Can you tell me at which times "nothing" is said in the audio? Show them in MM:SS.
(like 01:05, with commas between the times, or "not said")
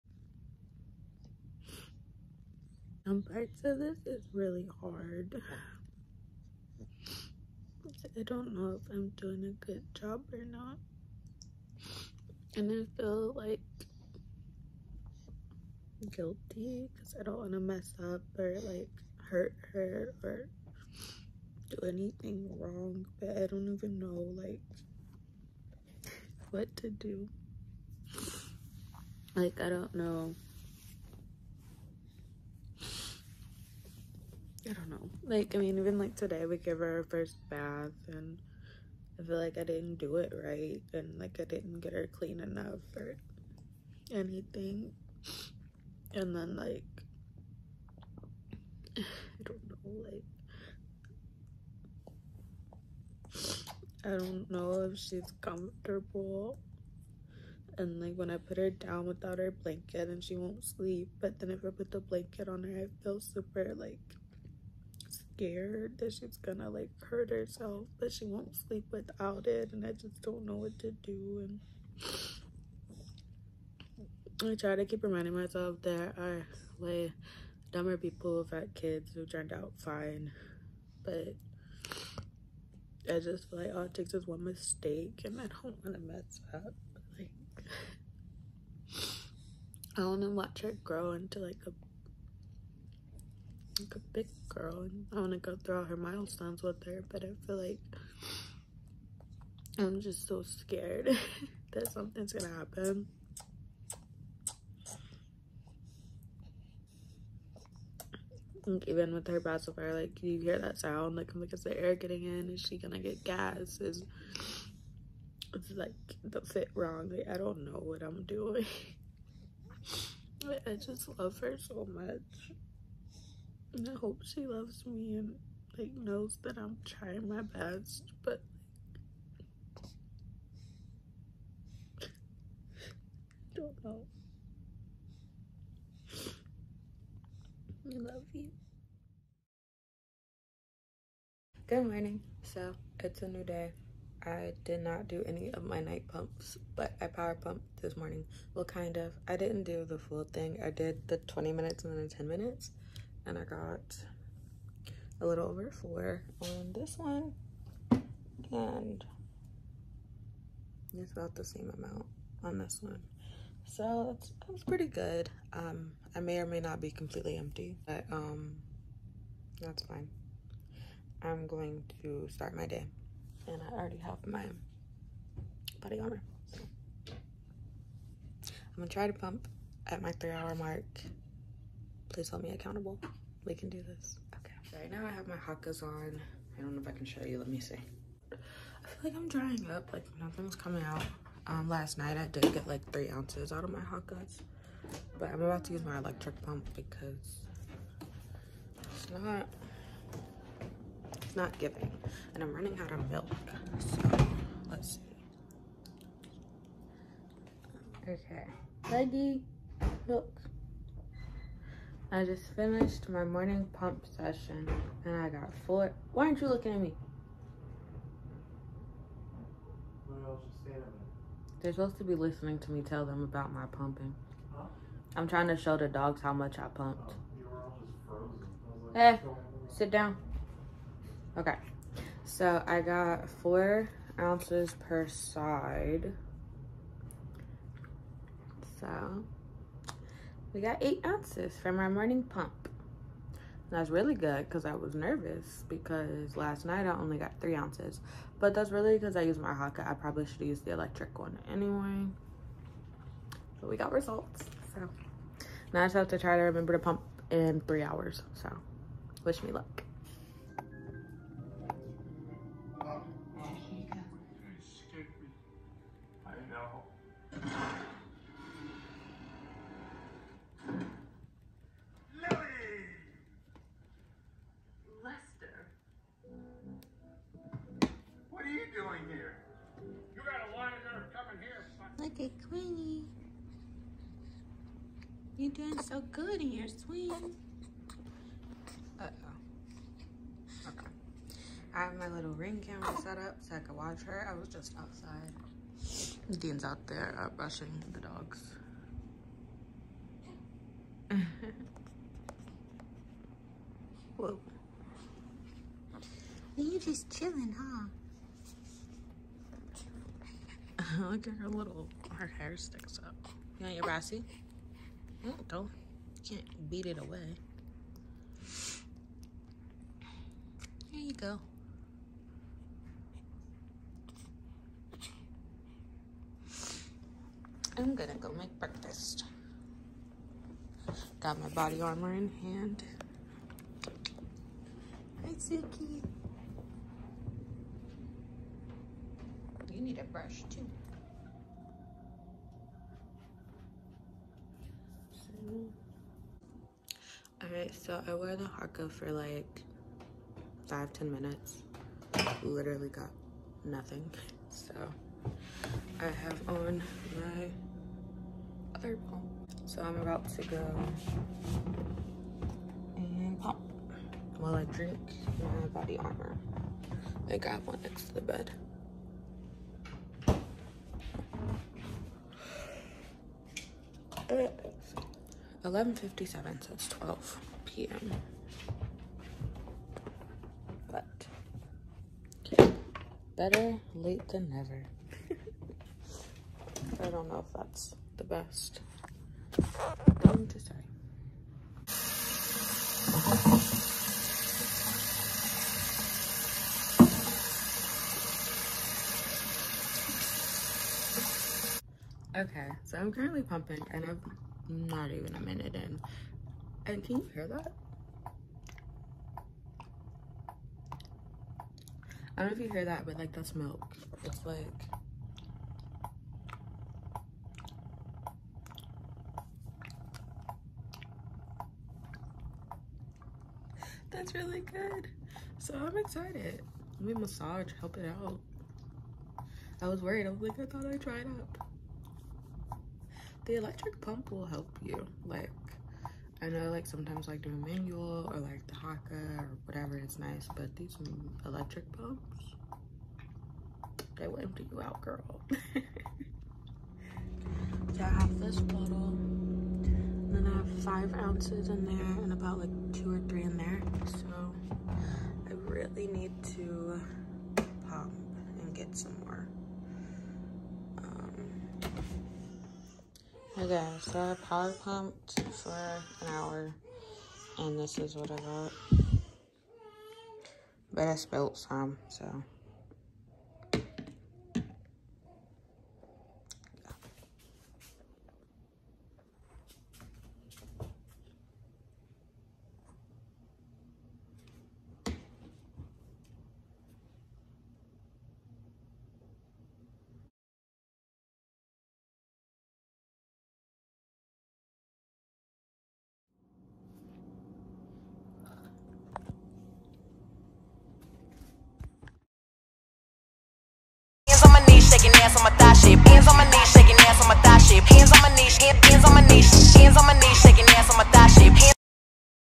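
03:10, 05:53.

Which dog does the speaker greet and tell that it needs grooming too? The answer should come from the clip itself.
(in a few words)
Suki.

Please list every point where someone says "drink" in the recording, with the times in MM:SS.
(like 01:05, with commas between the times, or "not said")
06:04.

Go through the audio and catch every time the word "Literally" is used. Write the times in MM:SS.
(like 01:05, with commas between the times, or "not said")
05:52.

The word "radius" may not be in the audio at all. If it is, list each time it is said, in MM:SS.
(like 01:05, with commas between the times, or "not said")
not said.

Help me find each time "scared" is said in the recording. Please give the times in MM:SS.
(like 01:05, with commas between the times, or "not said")
01:05, 01:40.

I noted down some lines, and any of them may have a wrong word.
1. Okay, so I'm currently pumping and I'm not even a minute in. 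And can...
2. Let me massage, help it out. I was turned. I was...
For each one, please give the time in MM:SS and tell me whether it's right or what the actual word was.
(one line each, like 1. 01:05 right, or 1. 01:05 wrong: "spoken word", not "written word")
1. 06:42 right
2. 07:07 wrong: "worried", not "turned".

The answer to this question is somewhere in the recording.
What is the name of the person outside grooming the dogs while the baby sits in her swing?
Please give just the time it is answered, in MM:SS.
04:56.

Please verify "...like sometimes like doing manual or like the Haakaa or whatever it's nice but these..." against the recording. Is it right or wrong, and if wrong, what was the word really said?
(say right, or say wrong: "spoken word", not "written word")
right.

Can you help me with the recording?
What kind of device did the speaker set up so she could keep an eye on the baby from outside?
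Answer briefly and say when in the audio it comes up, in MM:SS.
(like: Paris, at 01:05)
ring camera, at 04:52.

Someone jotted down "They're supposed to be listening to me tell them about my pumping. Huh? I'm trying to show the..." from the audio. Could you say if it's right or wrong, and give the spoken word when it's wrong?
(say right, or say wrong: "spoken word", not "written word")
right.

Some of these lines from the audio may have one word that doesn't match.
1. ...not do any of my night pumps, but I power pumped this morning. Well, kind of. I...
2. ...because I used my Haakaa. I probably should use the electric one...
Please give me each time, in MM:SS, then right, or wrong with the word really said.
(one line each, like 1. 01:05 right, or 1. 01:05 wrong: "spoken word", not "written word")
1. 02:24 right
2. 04:08 right.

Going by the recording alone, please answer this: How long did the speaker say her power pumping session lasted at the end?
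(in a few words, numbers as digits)
an hour.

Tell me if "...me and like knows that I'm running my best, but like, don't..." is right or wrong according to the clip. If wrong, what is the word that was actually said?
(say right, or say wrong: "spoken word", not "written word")
wrong: "trying", not "running".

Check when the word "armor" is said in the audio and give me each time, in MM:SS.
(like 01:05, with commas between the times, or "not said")
02:55, 05:31, 06:05.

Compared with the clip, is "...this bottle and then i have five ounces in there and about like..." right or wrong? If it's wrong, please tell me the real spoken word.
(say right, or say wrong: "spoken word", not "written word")
right.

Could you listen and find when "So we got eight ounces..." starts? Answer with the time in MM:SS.
03:58.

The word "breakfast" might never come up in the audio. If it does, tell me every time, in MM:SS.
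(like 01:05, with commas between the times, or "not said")
05:28.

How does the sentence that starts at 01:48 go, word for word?
even with her pacifier, like you hear that sound, like because is the air getting in?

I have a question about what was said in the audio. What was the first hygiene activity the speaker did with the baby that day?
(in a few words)
her first bath.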